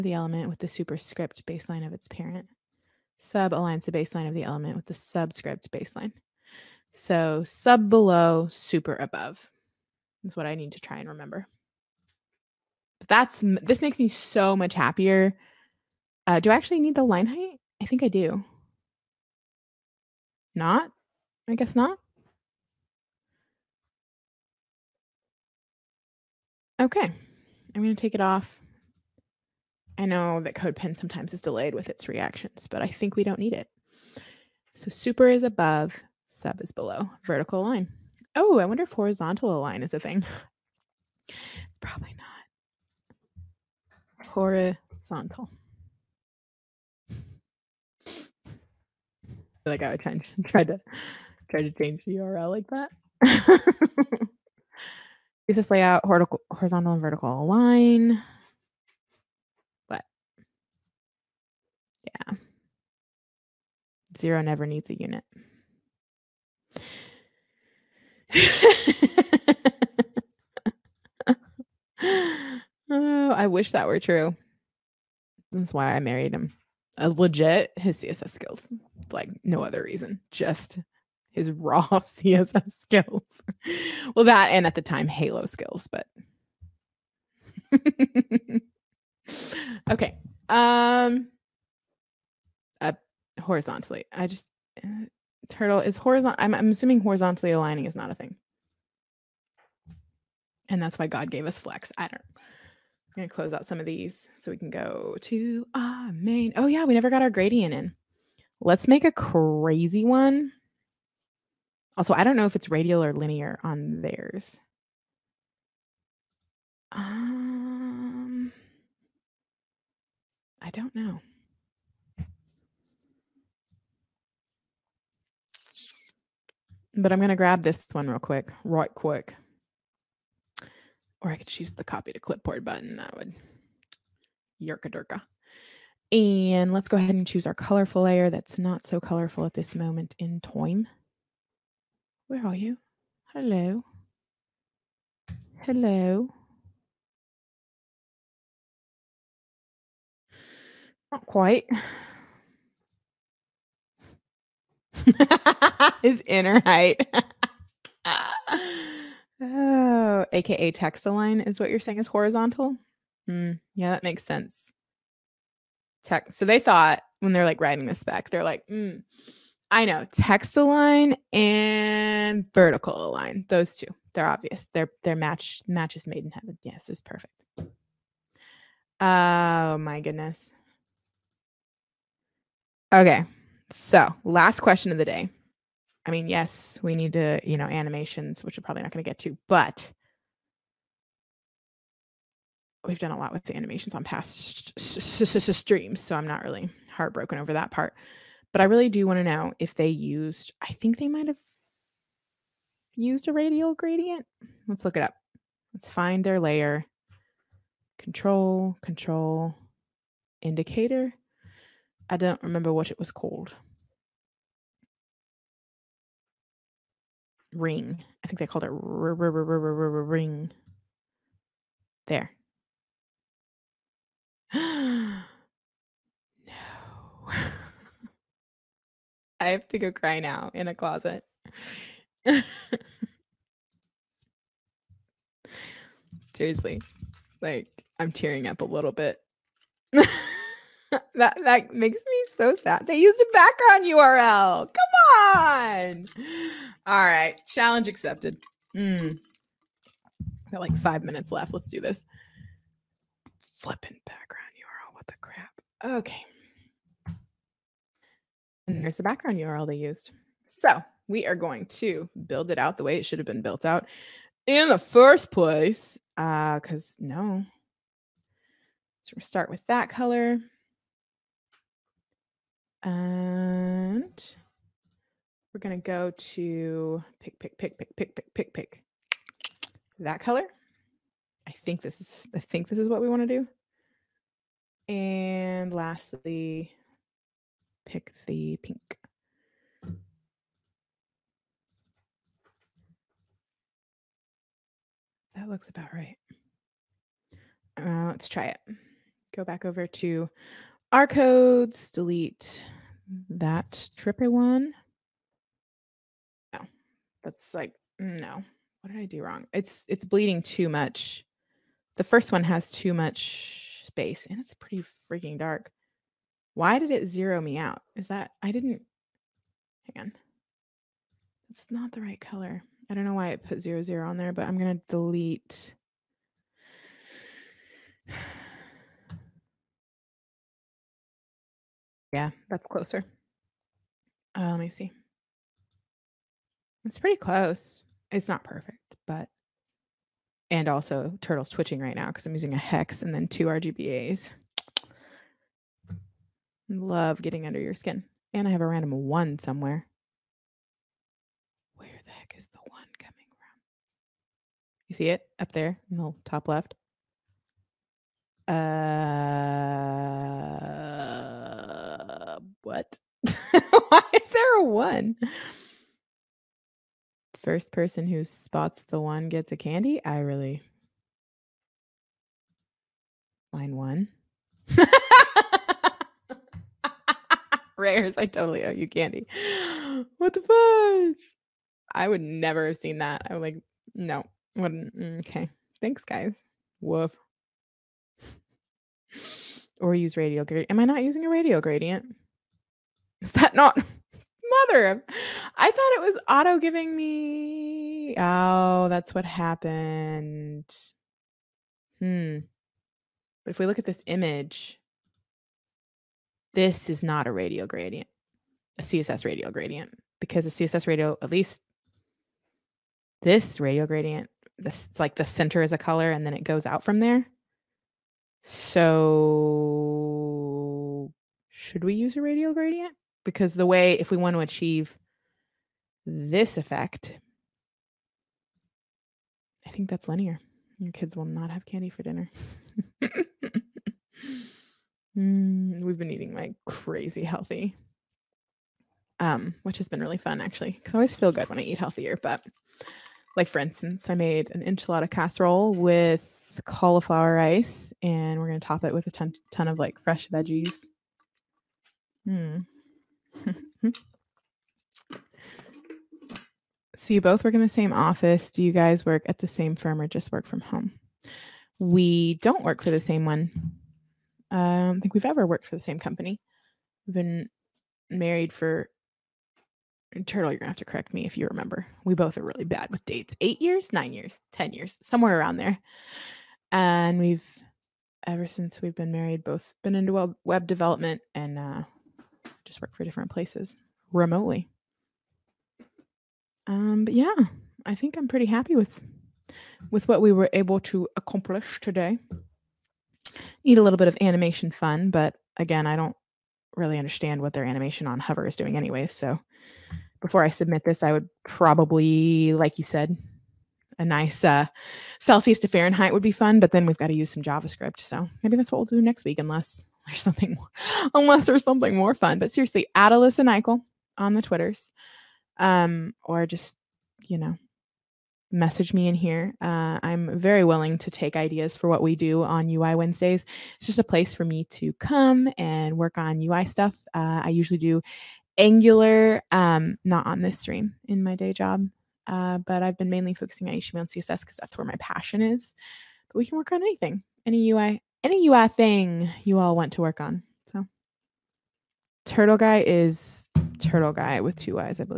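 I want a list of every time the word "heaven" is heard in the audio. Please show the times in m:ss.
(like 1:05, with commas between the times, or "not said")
2:56.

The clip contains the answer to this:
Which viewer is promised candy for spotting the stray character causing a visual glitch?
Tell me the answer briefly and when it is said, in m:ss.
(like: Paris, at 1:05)
Rares, at 6:17.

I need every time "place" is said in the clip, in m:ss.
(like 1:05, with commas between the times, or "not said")
4:25, 8:03, 8:44.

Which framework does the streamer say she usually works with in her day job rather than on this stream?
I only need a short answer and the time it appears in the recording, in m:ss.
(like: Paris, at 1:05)
Angular, at 8:48.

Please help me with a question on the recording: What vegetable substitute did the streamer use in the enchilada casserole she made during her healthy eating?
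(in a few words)
Cauliflower rice.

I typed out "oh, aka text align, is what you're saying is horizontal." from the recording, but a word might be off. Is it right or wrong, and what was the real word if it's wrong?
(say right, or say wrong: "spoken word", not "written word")
right.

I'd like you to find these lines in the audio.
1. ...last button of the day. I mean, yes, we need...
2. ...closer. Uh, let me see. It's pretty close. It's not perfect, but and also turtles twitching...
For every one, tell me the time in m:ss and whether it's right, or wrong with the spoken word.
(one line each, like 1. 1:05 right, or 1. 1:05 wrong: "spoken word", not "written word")
1. 3:04 wrong: "question", not "button"
2. 5:32 right.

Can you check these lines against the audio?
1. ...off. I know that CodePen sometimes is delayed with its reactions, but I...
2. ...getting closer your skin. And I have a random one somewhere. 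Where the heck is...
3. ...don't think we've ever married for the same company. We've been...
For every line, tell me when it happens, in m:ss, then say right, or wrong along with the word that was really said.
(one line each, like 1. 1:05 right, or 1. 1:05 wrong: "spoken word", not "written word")
1. 0:28 right
2. 5:47 wrong: "under", not "closer"
3. 7:44 wrong: "worked", not "married".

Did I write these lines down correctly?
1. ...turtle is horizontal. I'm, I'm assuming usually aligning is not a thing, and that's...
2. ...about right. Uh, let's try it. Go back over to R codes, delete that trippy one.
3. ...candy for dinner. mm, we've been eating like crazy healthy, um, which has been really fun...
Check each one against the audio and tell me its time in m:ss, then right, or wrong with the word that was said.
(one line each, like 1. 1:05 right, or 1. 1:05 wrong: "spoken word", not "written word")
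1. 1:35 wrong: "horizontally", not "usually"
2. 4:55 right
3. 7:11 right.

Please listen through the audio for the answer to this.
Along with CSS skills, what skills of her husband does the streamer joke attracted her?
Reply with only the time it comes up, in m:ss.
1:25.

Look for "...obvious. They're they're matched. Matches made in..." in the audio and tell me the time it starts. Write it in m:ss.
2:54.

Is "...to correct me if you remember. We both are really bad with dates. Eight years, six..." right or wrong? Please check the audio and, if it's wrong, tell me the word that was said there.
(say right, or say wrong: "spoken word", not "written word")
wrong: "nine", not "six".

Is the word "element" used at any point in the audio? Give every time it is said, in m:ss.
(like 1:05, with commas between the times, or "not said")
0:00, 0:04.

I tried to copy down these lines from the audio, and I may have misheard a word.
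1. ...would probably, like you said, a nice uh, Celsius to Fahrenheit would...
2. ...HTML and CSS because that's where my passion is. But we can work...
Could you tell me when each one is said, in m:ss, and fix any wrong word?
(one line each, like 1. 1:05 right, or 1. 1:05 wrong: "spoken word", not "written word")
1. 8:21 right
2. 8:53 right.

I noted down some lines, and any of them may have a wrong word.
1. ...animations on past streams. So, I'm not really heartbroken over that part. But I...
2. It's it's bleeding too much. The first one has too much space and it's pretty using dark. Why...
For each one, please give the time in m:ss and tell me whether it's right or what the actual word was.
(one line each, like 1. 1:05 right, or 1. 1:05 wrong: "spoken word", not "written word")
1. 3:13 right
2. 5:09 wrong: "freaking", not "using".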